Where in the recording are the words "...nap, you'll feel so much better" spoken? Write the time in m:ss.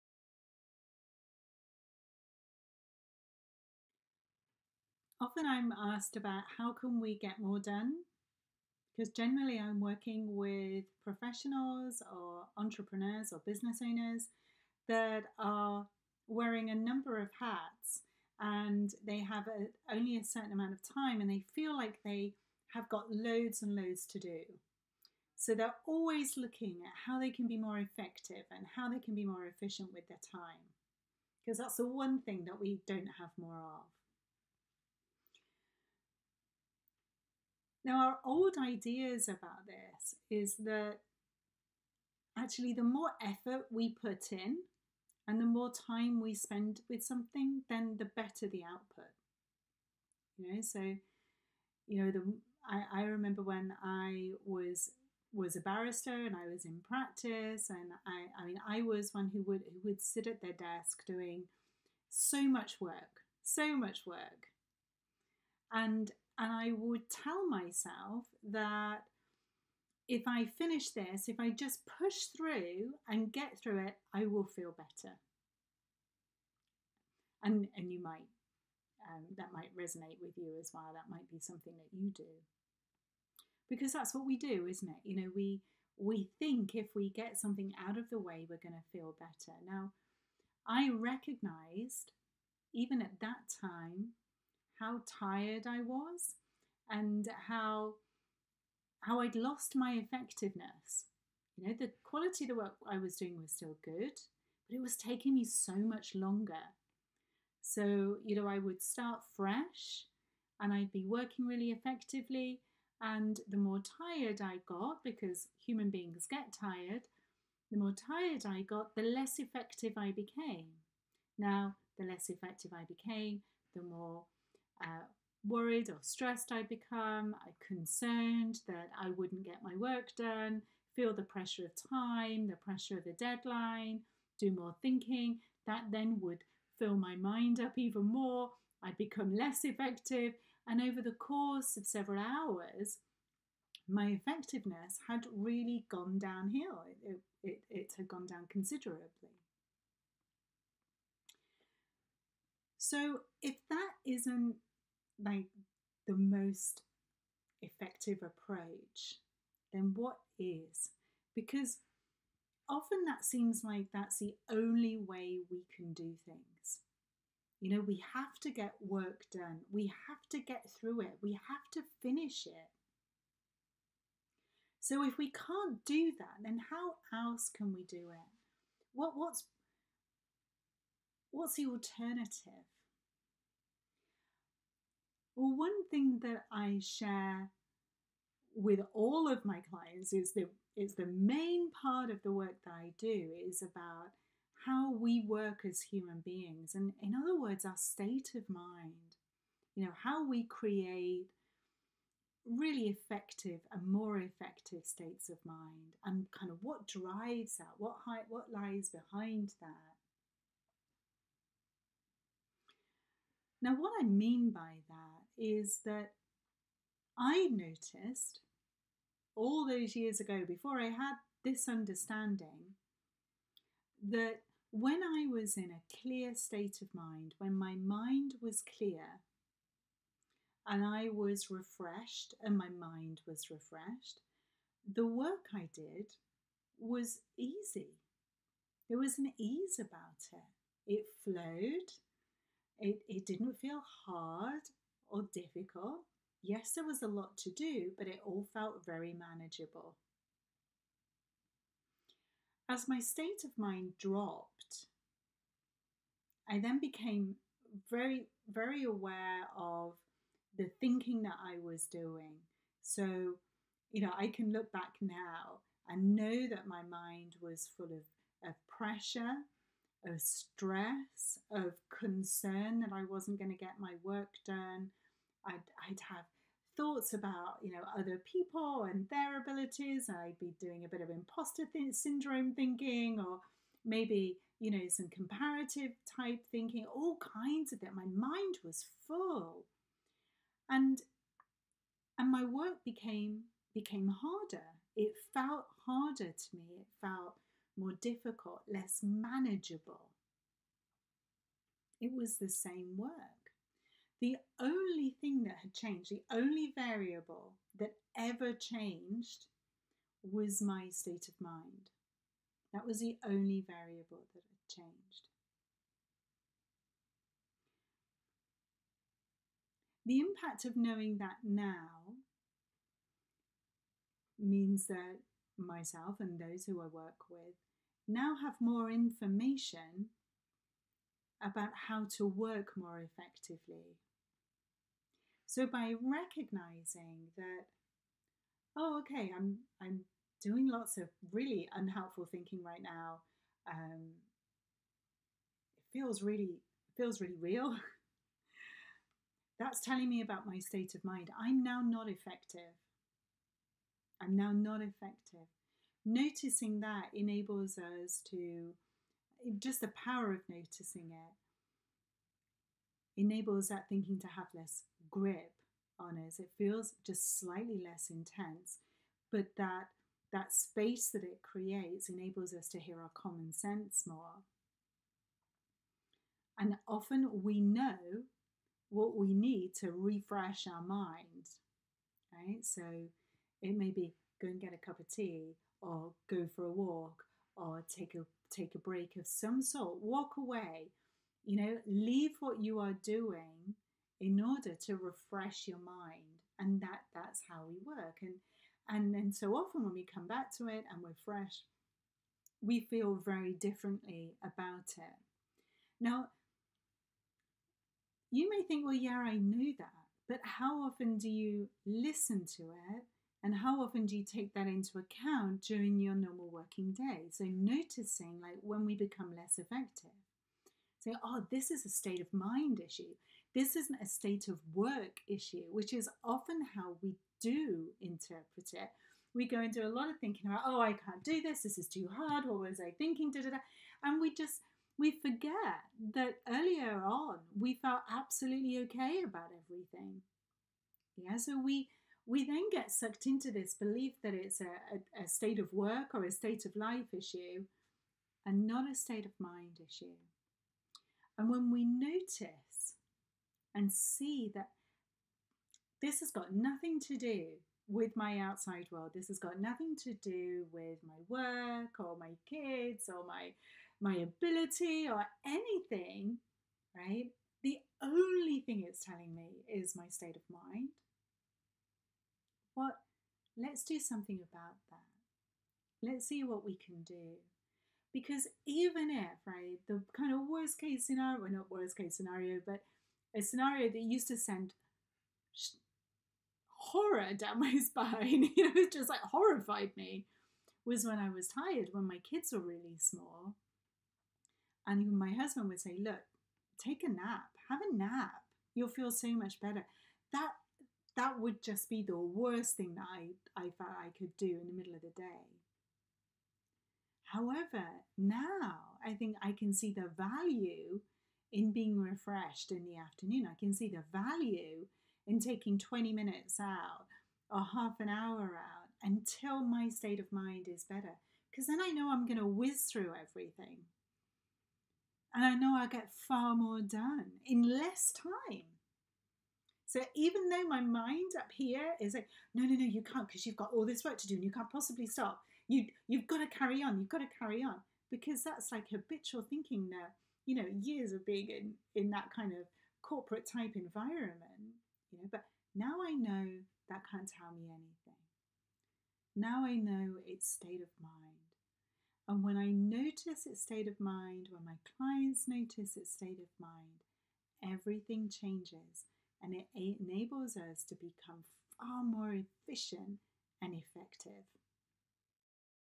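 8:17.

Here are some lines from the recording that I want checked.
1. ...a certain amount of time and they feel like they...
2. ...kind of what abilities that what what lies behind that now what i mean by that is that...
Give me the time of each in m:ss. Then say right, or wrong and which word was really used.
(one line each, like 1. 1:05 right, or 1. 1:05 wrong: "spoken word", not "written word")
1. 0:20 right
2. 3:26 wrong: "drives", not "abilities".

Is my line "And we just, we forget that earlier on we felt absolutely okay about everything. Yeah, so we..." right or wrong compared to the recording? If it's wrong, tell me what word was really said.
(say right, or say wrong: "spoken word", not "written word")
right.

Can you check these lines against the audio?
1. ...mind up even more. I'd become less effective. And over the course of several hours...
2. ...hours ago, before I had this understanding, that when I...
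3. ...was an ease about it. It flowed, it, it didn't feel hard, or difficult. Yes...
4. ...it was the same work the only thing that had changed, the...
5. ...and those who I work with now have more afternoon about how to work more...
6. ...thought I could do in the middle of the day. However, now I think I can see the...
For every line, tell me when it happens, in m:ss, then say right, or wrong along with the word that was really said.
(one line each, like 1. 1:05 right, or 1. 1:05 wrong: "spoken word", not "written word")
1. 2:17 right
2. 3:39 wrong: "years", not "hours"
3. 3:58 right
4. 5:01 right
5. 5:26 wrong: "information", not "afternoon"
6. 8:23 right.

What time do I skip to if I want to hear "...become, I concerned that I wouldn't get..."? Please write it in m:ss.
2:06.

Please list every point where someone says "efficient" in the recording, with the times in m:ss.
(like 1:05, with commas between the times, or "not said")
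0:29, 9:22.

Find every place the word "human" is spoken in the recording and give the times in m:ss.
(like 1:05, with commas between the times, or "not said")
1:55, 3:15.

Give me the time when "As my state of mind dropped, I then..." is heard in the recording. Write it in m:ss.
4:12.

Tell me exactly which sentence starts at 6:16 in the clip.
And often we know what we need to refresh our mind.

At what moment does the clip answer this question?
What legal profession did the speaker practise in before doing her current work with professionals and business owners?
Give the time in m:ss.
0:55.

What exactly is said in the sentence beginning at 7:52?
What let's do something about that.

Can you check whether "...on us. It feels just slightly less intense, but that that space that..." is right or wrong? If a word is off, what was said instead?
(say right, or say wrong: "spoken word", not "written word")
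right.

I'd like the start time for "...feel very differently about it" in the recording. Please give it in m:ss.
6:42.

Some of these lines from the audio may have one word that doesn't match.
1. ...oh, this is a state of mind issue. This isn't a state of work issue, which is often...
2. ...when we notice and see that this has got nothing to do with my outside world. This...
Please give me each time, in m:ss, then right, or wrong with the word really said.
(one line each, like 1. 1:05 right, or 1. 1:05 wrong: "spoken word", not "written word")
1. 7:01 right
2. 7:31 right.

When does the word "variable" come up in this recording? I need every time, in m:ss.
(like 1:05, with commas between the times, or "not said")
5:06, 5:13.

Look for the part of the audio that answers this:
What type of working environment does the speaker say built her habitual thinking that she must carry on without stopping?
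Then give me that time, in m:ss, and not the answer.
9:03.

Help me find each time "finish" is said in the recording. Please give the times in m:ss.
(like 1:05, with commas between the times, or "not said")
1:10, 2:52.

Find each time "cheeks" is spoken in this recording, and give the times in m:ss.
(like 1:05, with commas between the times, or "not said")
not said.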